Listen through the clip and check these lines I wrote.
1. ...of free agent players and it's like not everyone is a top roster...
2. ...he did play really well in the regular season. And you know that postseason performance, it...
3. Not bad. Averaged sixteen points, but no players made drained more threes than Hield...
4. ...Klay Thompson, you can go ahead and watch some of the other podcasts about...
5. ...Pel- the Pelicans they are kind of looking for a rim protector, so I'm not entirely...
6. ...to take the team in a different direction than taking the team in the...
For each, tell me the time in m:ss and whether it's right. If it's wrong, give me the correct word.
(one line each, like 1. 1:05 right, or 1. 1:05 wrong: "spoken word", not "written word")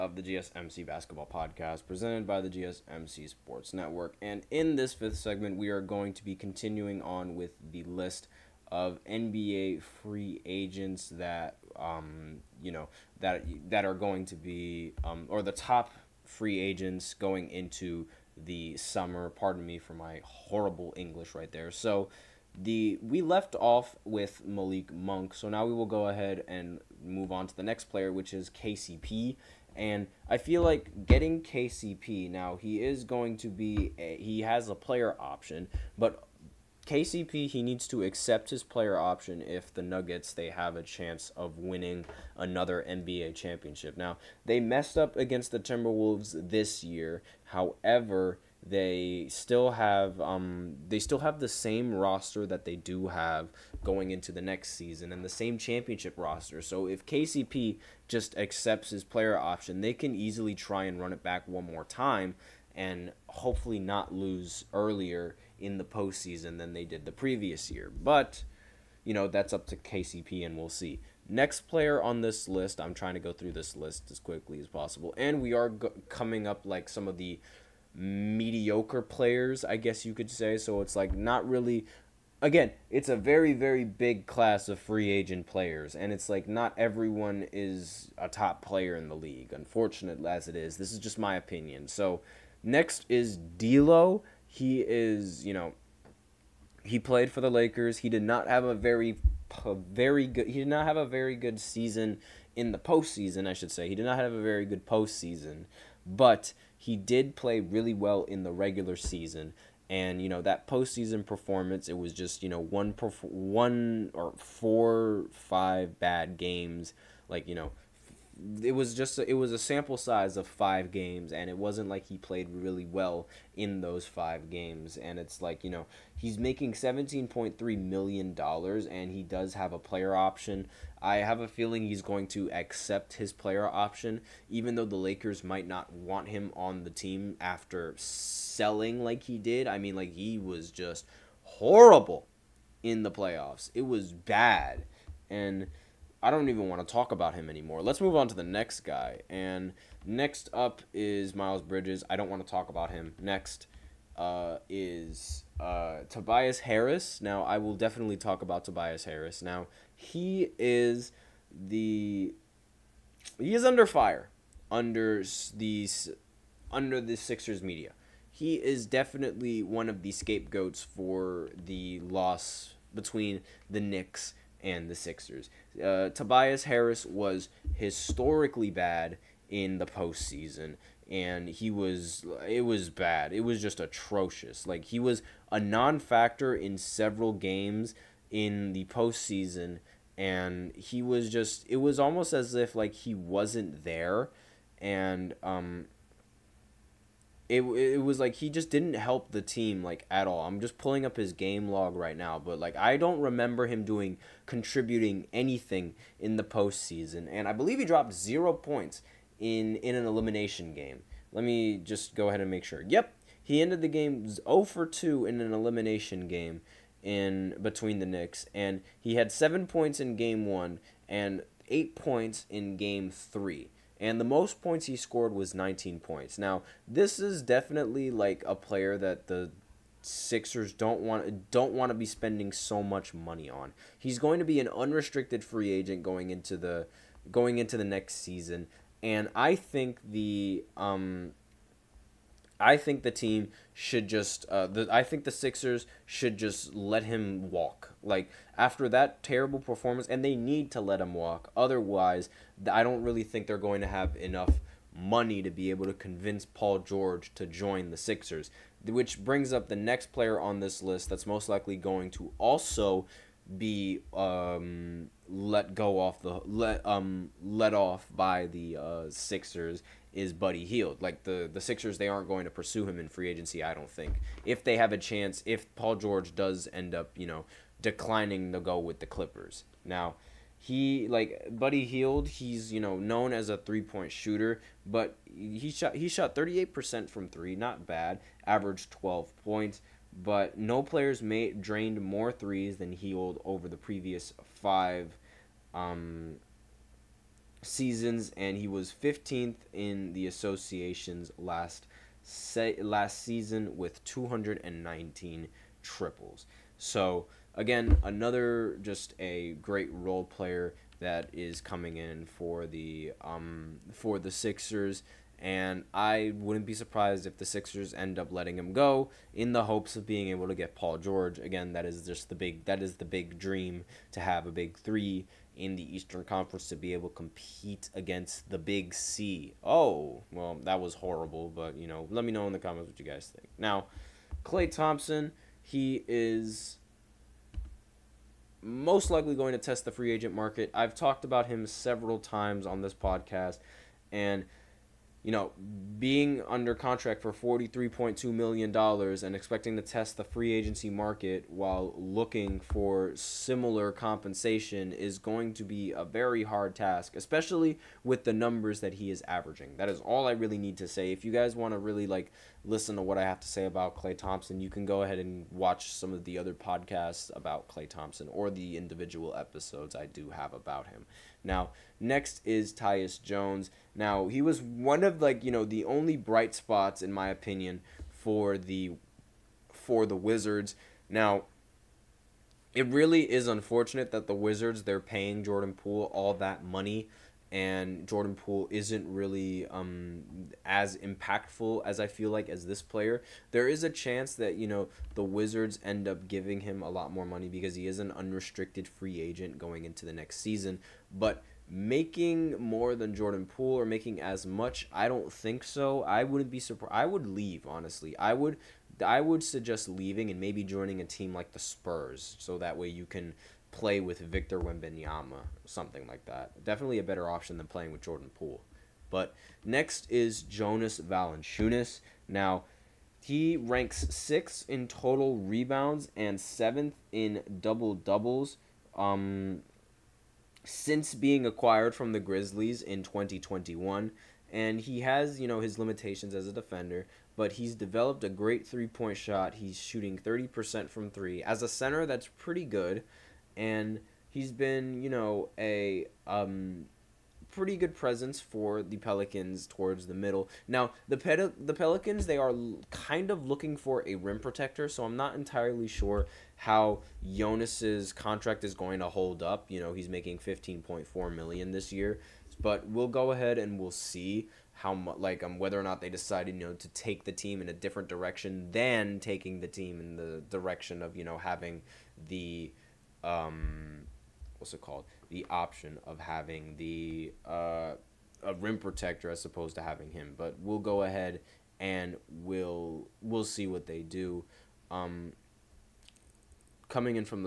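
1. 1:24 wrong: "player", not "roster"
2. 1:46 right
3. 4:47 wrong: "twelve", not "sixteen"
4. 6:03 right
5. 7:31 right
6. 7:46 right.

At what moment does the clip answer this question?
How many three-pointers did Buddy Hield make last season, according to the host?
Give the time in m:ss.
5:04.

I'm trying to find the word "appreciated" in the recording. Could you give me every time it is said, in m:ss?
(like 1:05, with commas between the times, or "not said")
not said.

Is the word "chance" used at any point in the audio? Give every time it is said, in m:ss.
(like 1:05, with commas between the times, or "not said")
0:40, 4:34, 6:33.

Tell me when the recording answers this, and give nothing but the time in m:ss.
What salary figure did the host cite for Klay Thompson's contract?
5:47.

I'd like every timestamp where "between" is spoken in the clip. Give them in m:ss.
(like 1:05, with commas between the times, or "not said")
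2:52, 3:37.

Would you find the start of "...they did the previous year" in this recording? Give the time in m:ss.
1:06.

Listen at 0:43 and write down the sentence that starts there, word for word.
Now, they messed up against the Timberwolves this year.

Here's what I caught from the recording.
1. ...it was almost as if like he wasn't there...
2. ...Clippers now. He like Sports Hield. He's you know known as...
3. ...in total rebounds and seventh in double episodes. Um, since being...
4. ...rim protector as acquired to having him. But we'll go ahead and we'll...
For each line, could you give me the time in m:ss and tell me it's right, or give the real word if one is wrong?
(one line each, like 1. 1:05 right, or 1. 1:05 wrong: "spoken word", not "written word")
1. 3:11 right
2. 4:39 wrong: "Buddy", not "Sports"
3. 7:04 wrong: "doubles", not "episodes"
4. 7:58 wrong: "opposed", not "acquired".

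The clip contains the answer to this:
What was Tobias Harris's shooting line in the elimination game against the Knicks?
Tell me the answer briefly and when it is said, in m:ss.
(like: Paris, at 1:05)
0 for 2, at 3:34.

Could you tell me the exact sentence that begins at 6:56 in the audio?
Definitely a better option than playing with Jordan Poole.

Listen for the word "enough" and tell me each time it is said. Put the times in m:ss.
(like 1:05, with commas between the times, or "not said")
4:14.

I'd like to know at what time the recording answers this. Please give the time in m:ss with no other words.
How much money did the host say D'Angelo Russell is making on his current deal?
2:06.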